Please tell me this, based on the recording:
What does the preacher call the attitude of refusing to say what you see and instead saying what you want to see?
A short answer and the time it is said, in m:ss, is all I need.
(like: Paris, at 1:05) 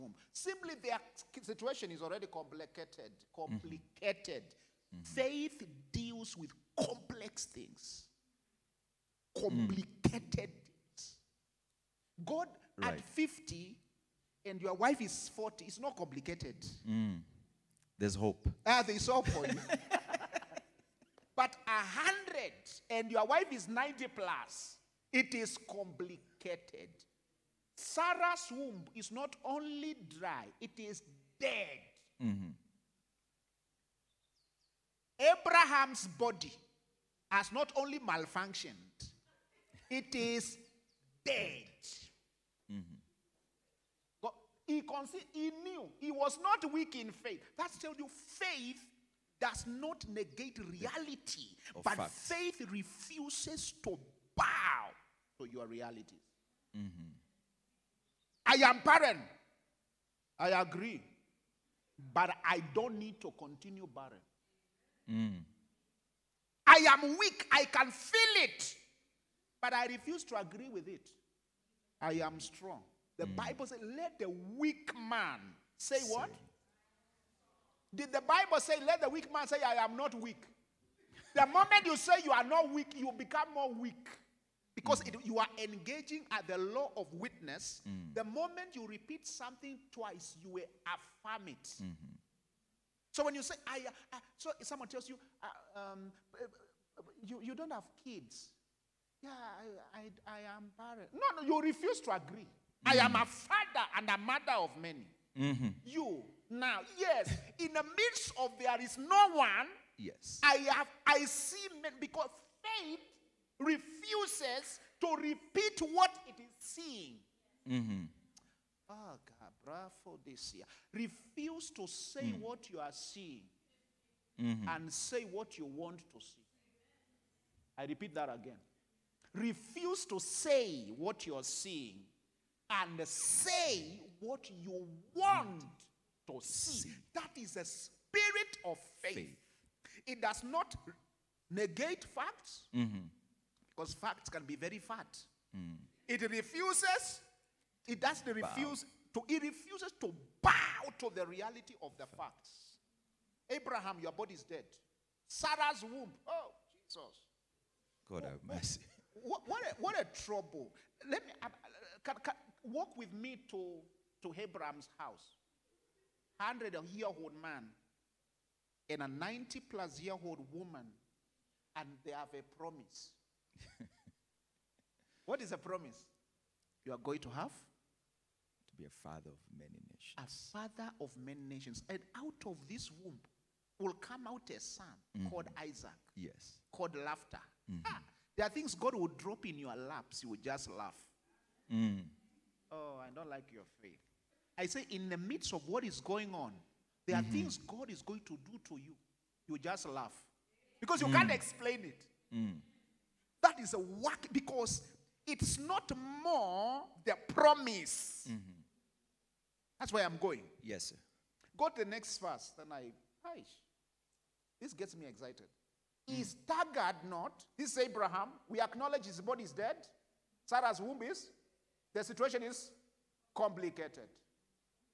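spirit of faith, at 2:17.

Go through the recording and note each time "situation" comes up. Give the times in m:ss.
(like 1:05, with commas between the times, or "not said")
0:01, 3:42.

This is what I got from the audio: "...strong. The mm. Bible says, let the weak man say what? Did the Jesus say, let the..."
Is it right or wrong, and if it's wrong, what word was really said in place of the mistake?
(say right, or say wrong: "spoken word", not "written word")
wrong: "Bible", not "Jesus".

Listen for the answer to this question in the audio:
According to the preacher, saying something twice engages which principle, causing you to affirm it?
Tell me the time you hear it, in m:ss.
1:26.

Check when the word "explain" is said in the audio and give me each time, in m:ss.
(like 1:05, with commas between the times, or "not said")
3:21.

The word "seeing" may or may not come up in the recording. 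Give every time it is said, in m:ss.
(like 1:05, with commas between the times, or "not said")
1:56, 2:02, 2:11.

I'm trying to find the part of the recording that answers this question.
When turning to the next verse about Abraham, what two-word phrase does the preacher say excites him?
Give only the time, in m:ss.
3:36.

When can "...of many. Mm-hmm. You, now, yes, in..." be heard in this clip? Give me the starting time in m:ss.
1:44.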